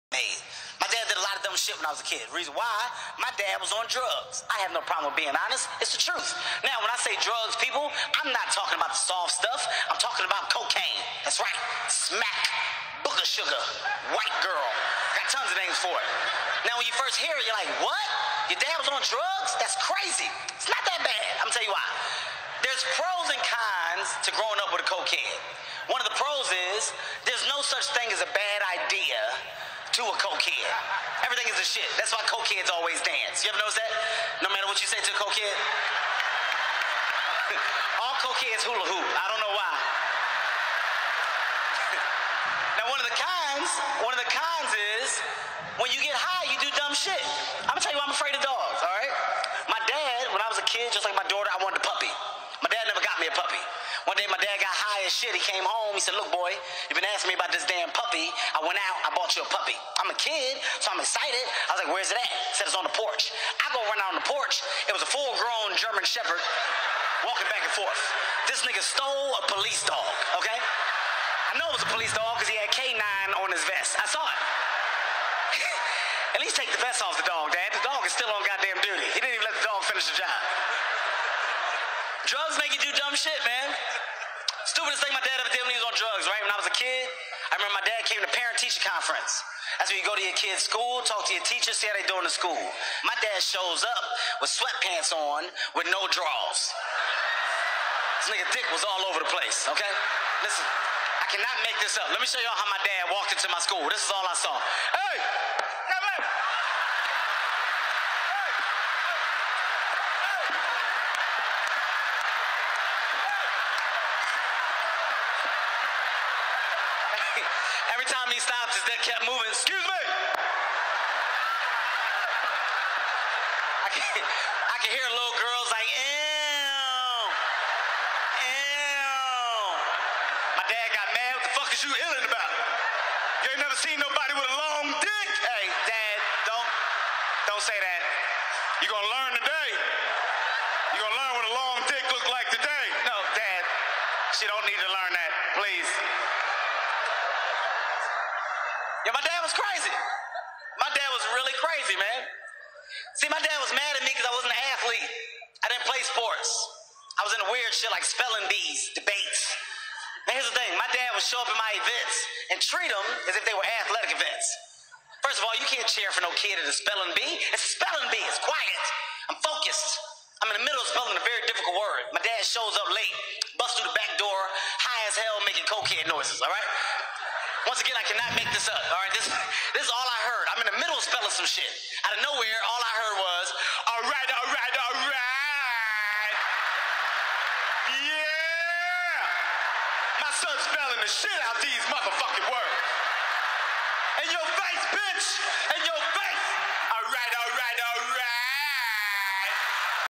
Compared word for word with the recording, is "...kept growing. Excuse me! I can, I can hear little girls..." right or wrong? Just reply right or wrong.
wrong.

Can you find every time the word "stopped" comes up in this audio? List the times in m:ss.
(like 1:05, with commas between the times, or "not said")
1:58.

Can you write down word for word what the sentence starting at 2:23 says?
No, dad, she don't need to learn that, please.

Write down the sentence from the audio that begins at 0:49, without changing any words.
My dad, when I was a kid, just like my daughter, I wanted a puppy.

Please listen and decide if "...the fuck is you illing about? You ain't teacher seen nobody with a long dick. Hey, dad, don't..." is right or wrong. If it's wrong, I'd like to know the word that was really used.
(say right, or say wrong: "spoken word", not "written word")
wrong: "never", not "teacher".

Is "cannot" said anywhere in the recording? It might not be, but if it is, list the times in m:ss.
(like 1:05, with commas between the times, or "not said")
1:41, 2:58.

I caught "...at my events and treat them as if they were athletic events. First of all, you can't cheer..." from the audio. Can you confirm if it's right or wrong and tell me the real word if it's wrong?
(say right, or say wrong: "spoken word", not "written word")
right.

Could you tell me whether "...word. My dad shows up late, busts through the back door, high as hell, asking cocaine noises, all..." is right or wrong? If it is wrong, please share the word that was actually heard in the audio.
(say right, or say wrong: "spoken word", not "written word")
wrong: "making", not "asking".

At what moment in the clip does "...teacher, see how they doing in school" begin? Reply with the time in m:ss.
1:31.